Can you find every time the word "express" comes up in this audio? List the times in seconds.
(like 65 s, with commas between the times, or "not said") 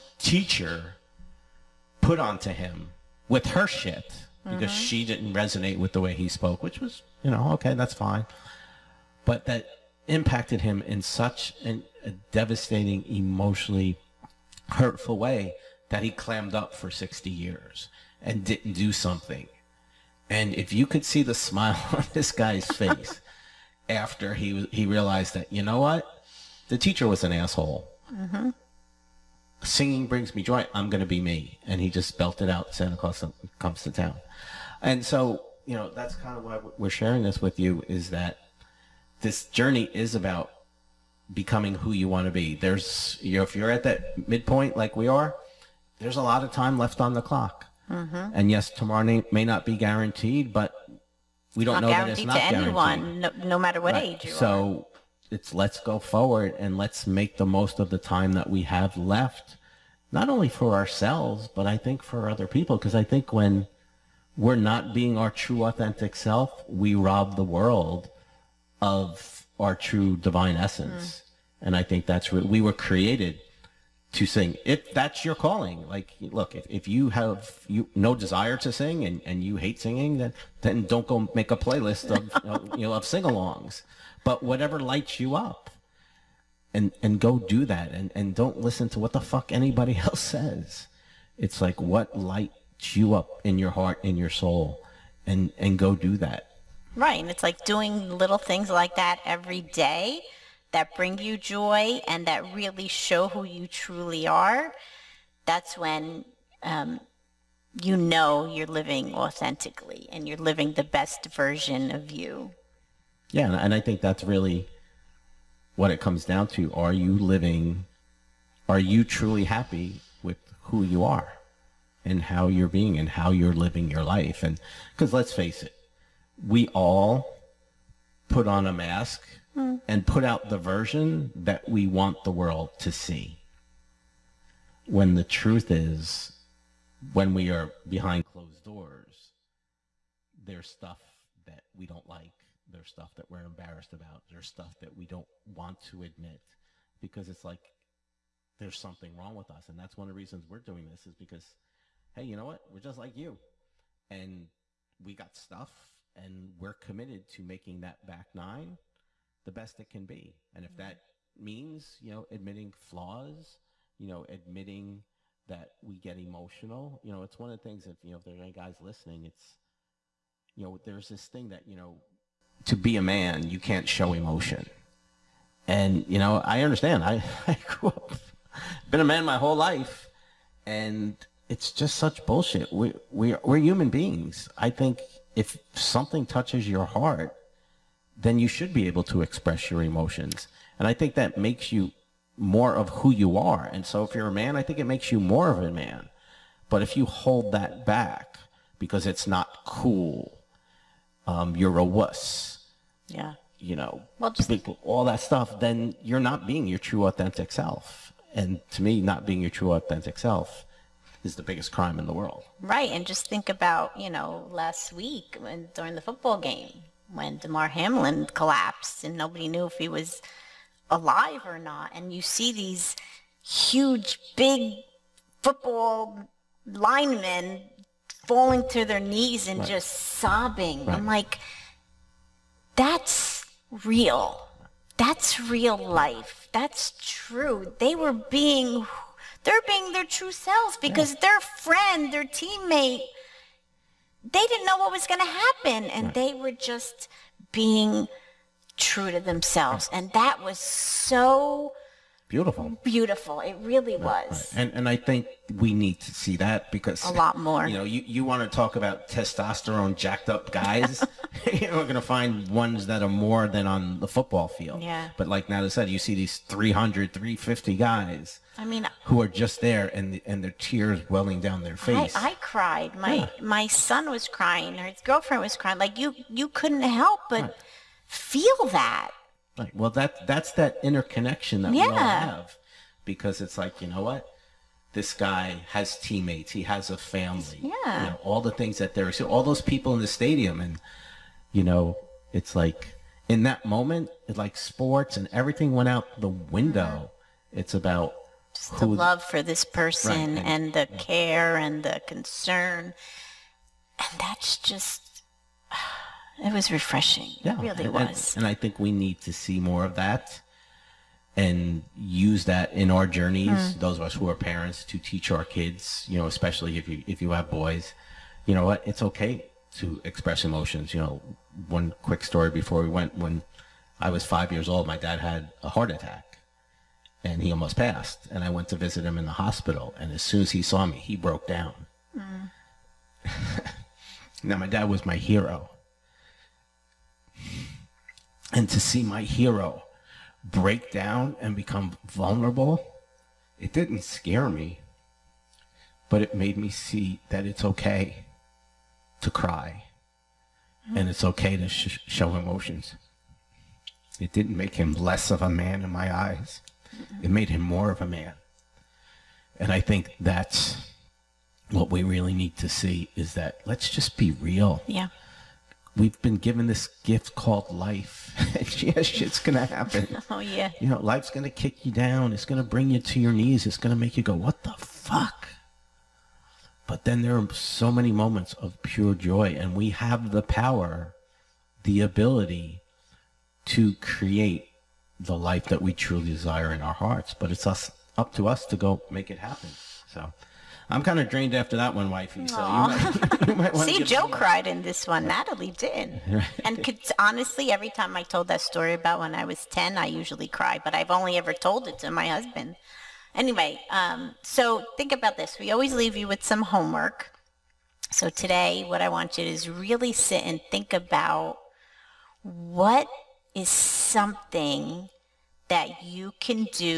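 189 s, 320 s.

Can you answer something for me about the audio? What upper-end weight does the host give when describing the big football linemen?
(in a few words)
350.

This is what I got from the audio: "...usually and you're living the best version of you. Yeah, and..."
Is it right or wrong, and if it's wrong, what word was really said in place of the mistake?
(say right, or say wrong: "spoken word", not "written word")
wrong: "authentically", not "usually".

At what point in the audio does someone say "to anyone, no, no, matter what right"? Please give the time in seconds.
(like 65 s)
52 s.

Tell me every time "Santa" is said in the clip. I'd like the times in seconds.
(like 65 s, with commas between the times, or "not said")
32 s.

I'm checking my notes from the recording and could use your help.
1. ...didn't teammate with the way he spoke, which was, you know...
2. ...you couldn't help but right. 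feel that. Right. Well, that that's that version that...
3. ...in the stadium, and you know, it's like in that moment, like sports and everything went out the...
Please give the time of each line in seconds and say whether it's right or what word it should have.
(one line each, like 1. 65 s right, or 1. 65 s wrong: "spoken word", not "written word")
1. 5 s wrong: "resonate", not "teammate"
2. 276 s wrong: "interconnection", not "version"
3. 289 s right.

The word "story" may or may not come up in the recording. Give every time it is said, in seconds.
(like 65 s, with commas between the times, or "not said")
322 s, 398 s.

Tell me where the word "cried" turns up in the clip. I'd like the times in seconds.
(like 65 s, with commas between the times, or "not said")
272 s, 394 s.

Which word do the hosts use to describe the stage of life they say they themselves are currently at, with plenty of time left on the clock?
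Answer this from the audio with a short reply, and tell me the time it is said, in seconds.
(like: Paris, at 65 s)
midpoint, at 44 s.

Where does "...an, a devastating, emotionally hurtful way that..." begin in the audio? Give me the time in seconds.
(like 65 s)
11 s.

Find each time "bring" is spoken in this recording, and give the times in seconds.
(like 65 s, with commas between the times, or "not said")
30 s, 100 s, 372 s.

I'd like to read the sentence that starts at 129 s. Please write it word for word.
and put out the version that we want the world to see.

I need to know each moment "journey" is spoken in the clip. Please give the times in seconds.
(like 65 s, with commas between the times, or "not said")
39 s, 313 s.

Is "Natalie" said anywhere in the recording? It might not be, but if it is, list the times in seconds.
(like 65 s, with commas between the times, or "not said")
265 s, 395 s.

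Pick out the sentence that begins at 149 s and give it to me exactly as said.
And that's one of the reasons we're doing this is because, hey, you know what?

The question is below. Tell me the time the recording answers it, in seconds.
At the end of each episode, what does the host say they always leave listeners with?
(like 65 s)
406 s.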